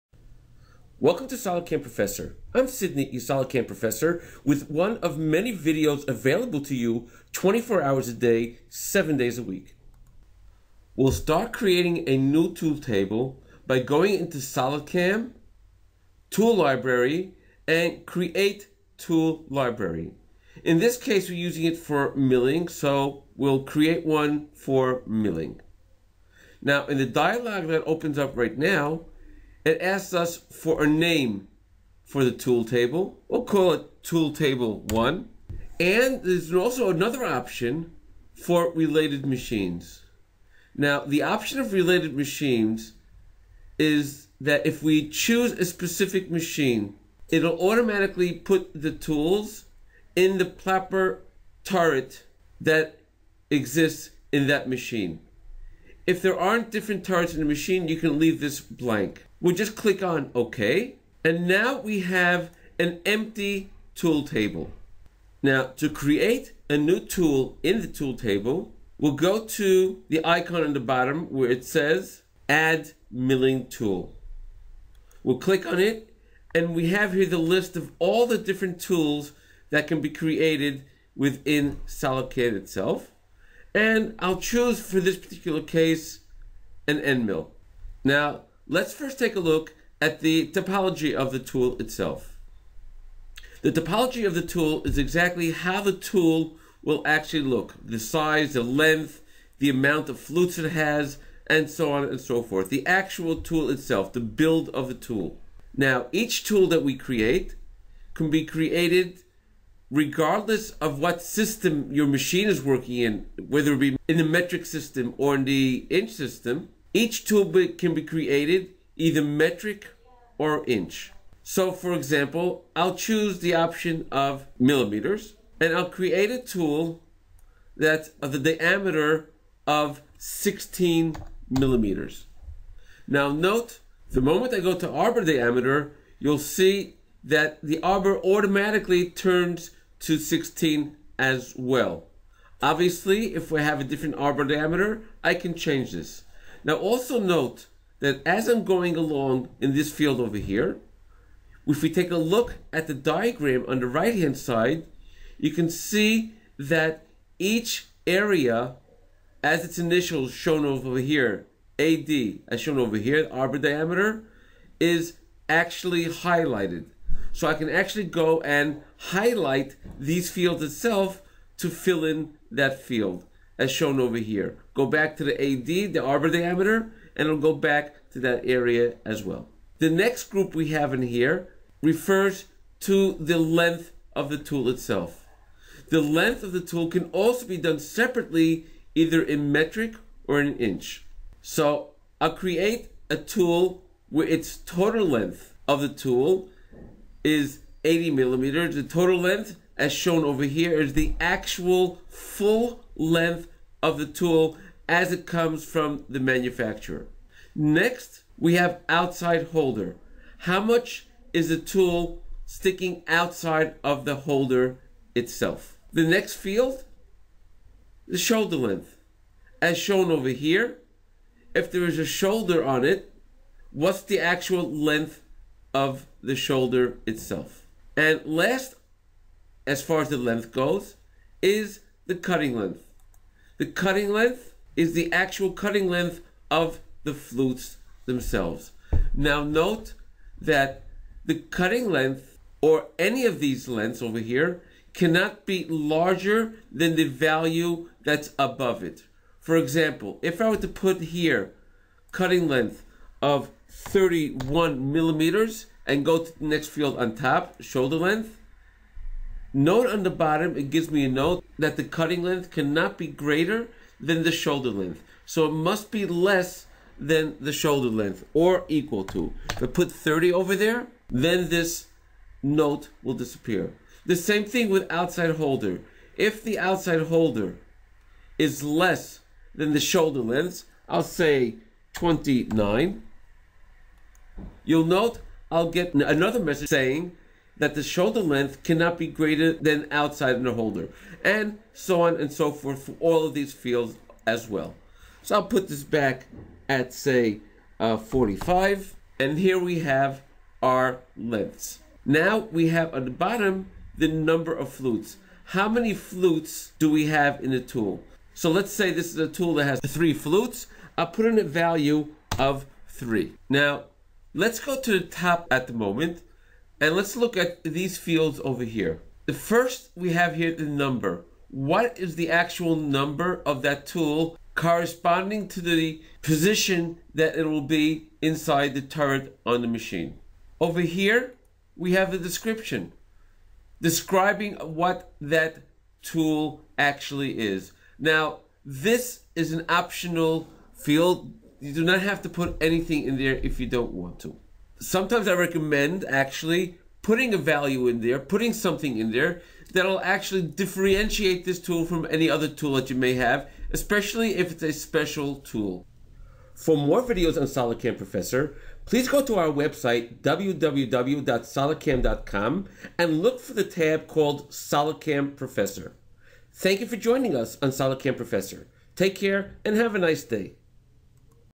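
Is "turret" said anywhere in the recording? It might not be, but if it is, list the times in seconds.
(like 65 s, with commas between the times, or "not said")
51 s, 57 s, 328 s.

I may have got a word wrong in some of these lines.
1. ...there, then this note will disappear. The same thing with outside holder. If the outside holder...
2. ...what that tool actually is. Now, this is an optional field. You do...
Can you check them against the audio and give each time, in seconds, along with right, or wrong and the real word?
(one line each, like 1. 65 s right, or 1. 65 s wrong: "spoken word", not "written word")
1. 270 s right
2. 334 s right.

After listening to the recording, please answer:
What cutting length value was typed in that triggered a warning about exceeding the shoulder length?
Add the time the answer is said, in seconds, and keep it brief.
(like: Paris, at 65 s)
31 millimeters, at 253 s.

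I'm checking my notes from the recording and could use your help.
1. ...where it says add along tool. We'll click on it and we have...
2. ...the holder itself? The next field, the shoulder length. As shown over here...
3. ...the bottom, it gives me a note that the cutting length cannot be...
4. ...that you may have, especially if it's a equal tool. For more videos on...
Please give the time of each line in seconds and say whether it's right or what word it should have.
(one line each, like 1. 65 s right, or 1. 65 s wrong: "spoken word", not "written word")
1. 71 s wrong: "milling", not "along"
2. 214 s right
3. 260 s right
4. 352 s wrong: "special", not "equal".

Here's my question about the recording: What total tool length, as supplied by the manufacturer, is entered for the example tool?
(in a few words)
80 millimeters.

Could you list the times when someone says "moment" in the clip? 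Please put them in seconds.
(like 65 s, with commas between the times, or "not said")
134 s, 315 s.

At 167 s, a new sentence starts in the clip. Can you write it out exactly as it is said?
So I can actually go and highlight these fields itself to fill in that field as shown over here.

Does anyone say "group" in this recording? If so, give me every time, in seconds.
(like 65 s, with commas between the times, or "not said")
180 s.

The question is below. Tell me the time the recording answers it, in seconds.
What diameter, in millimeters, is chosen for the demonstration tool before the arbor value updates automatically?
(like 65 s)
130 s.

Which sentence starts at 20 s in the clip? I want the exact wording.
In this case, we're using it for milling, so we'll create one for milling.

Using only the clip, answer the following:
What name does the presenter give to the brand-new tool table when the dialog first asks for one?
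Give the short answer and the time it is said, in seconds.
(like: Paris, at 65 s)
tool table one, at 34 s.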